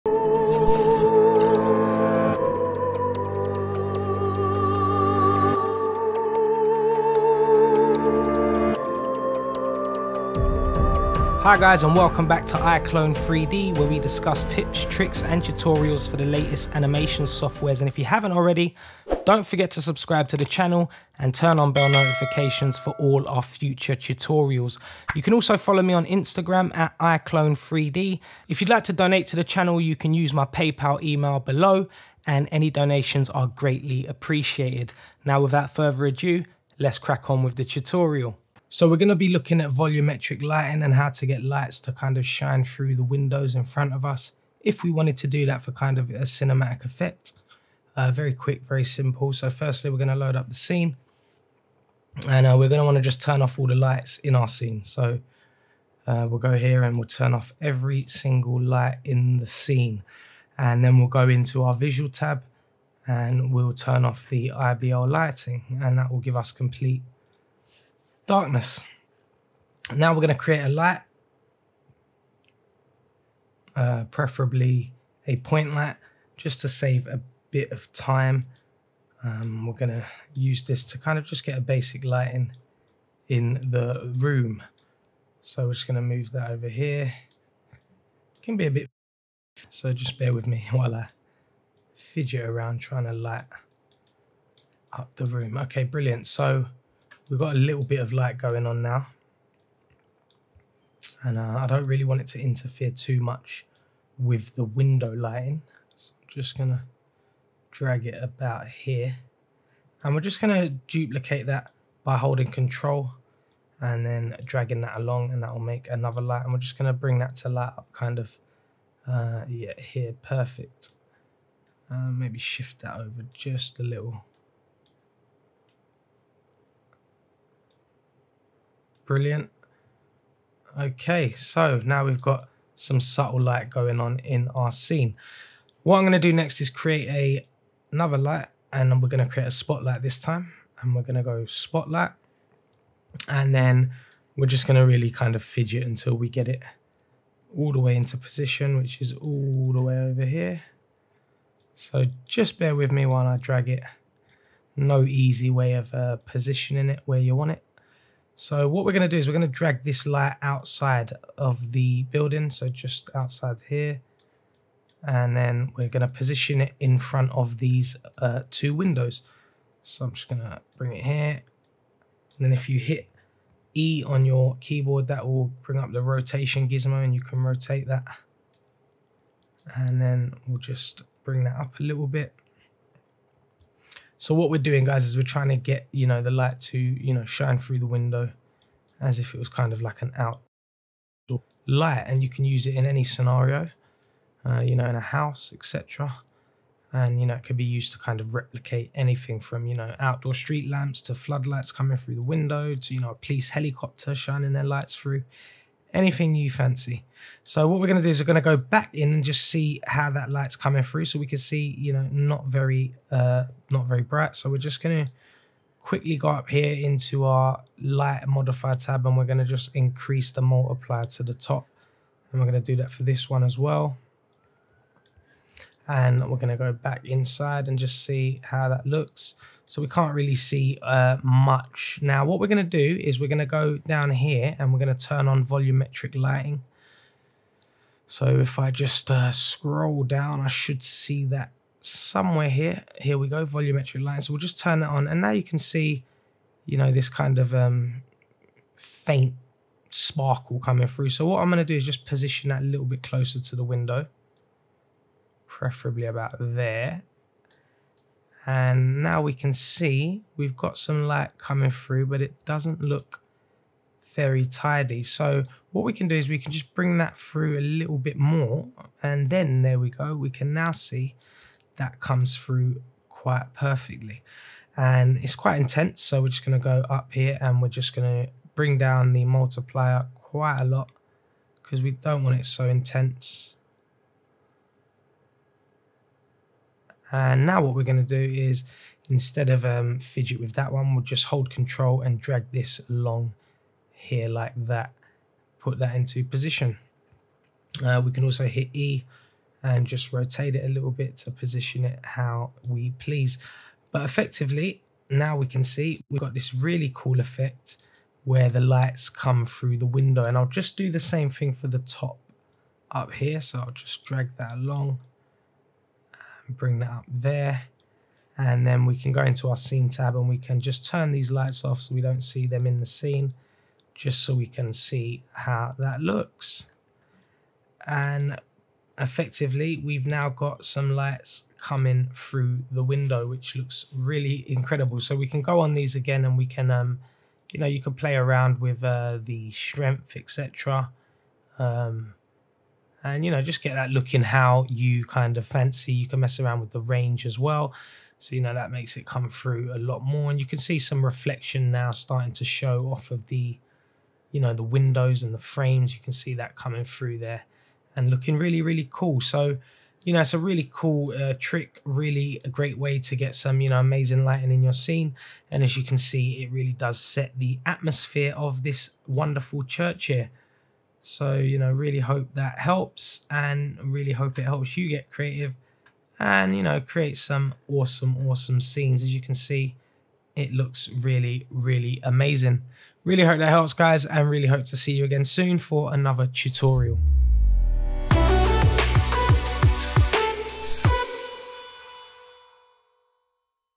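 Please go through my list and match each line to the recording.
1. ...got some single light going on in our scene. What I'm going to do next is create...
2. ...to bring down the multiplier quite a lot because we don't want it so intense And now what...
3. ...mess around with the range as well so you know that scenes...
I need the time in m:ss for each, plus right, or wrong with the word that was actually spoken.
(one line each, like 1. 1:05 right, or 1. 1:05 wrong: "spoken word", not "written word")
1. 2:12 wrong: "subtle", not "single"
2. 4:38 right
3. 5:46 wrong: "makes", not "scenes".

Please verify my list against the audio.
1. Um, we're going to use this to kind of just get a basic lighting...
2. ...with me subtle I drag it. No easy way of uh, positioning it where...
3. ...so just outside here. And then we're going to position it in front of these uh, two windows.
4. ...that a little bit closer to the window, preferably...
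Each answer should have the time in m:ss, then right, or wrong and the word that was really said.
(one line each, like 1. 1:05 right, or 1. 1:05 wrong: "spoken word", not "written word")
1. 1:19 right
2. 2:32 wrong: "while", not "subtle"
3. 2:42 right
4. 4:12 right.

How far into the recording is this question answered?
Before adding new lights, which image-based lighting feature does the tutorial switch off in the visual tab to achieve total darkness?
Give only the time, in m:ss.
1:04.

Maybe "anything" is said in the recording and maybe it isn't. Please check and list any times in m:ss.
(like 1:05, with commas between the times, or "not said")
3:18, 3:25.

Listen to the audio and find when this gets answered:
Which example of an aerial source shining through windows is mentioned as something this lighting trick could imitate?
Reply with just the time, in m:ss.
3:23.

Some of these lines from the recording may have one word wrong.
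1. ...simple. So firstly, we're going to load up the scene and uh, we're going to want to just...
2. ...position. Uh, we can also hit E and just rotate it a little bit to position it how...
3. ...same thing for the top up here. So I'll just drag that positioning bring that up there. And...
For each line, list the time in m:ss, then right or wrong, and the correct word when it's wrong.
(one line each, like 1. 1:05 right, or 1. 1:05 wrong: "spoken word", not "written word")
1. 0:48 right
2. 4:56 right
3. 5:10 wrong: "along", not "positioning".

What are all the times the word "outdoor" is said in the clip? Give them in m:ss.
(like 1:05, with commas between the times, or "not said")
3:10, 3:19.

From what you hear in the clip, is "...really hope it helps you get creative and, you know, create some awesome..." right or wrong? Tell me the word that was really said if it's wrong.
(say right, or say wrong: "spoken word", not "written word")
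right.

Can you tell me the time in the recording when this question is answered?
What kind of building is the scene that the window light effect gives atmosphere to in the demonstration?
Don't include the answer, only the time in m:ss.
6:09.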